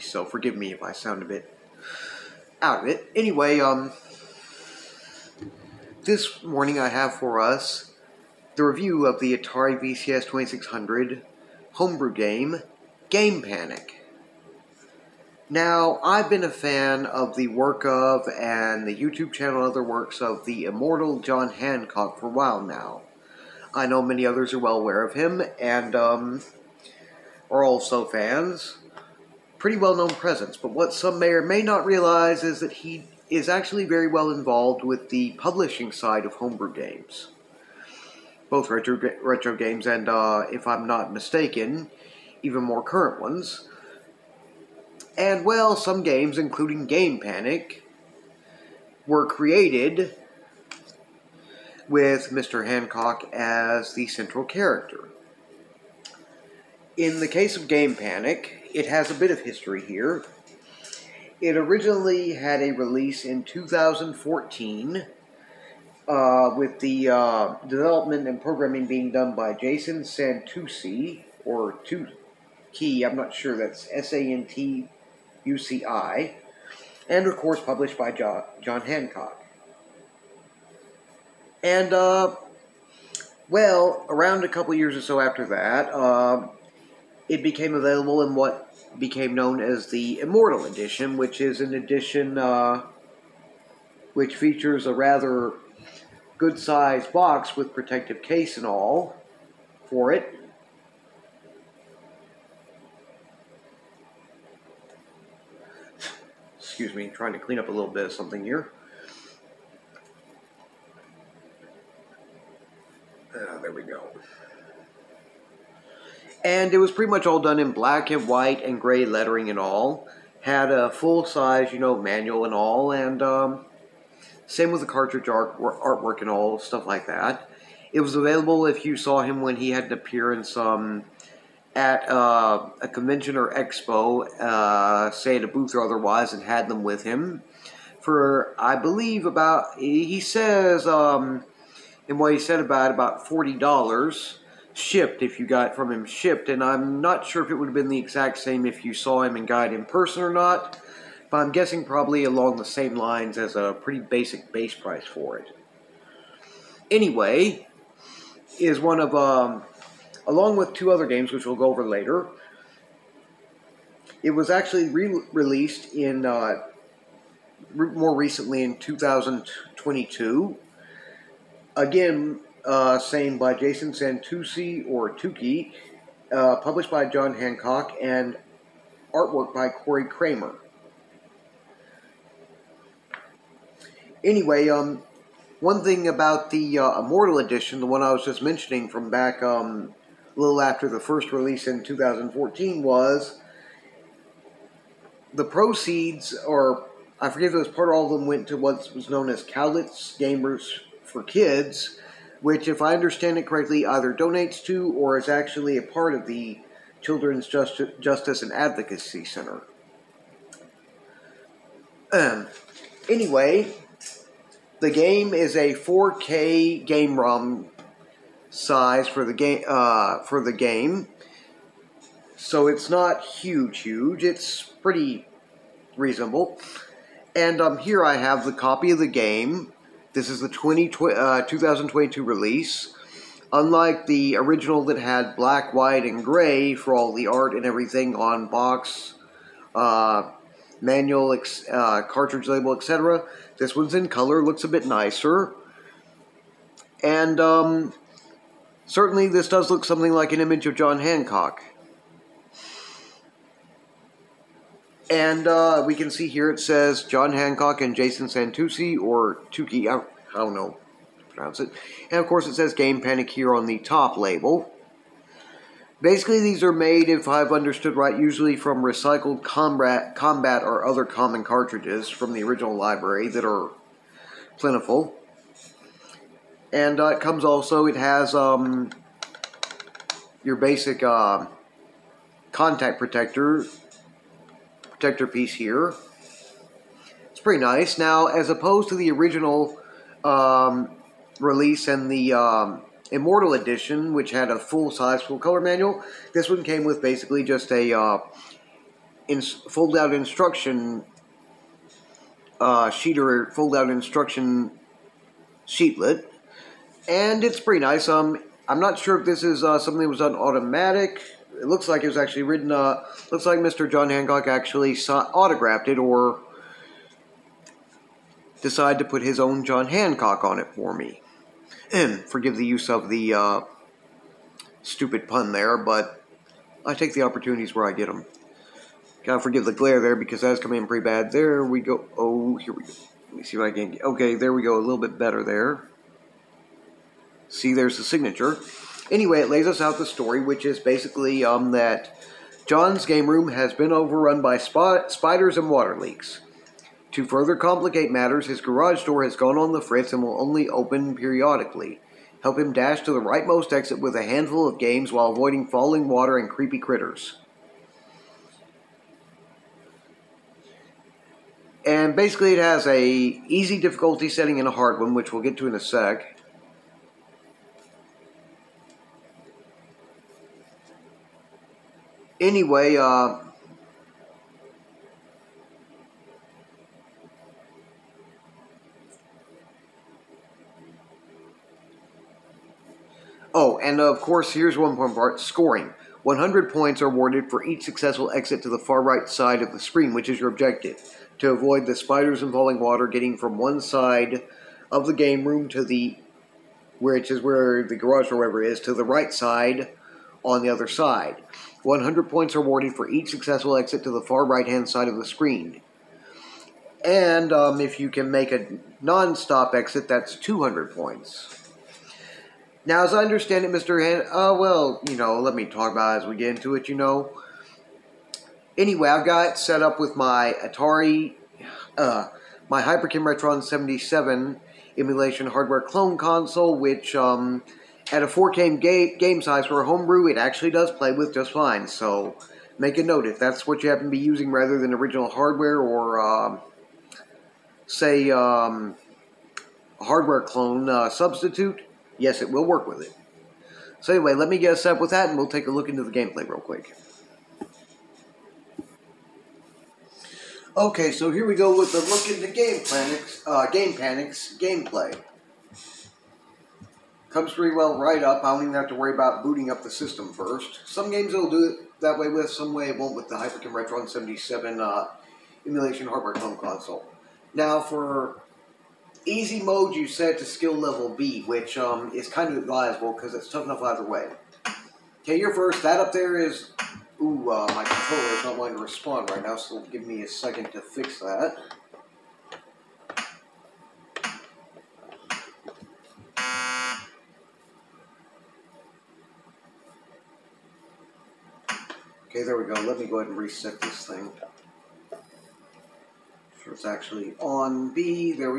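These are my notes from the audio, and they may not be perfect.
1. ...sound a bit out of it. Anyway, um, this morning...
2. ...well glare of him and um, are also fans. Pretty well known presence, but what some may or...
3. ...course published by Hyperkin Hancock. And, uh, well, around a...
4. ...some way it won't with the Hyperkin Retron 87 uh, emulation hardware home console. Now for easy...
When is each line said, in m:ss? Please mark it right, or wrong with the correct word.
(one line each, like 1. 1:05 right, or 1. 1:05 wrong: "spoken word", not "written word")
1. 0:00 right
2. 0:24 wrong: "aware", not "glare"
3. 1:17 wrong: "John", not "Hyperkin"
4. 7:42 wrong: "77", not "87".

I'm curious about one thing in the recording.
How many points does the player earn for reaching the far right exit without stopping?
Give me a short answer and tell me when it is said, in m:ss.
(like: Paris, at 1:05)
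200, at 6:50.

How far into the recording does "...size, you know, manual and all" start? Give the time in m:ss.
2:01.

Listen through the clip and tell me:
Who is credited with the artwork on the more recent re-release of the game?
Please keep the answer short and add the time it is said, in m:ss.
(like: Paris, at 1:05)
Corey Kramer, at 2:59.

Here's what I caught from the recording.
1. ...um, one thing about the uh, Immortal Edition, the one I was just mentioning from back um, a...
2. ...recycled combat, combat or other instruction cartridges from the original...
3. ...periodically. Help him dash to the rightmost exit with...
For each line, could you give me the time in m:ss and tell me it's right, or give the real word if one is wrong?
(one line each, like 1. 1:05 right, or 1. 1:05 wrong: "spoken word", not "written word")
1. 3:04 right
2. 4:28 wrong: "common", not "instruction"
3. 5:51 right.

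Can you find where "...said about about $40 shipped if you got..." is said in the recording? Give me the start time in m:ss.
2:22.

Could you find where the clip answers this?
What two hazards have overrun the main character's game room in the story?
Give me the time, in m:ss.
5:44.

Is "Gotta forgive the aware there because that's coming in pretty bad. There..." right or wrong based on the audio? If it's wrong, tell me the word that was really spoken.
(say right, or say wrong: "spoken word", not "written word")
wrong: "glare", not "aware".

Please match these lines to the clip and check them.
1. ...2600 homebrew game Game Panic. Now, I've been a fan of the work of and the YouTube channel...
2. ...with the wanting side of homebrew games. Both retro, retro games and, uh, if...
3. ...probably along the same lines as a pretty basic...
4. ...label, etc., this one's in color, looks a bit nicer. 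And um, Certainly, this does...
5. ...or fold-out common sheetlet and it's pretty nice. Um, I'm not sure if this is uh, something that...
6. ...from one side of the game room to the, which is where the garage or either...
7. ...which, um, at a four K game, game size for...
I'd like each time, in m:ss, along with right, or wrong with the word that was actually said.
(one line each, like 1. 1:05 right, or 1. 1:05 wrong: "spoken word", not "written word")
1. 0:10 right
2. 0:34 wrong: "publishing", not "wanting"
3. 2:31 right
4. 4:02 right
5. 5:03 wrong: "instruction", not "common"
6. 6:33 wrong: "whatever", not "either"
7. 7:06 right.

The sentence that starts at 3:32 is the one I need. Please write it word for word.
Um, anyway, the game is a 4K game ROM size for the game uh, for the game.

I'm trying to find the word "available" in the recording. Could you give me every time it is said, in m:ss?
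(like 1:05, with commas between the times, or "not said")
1:27, 2:08.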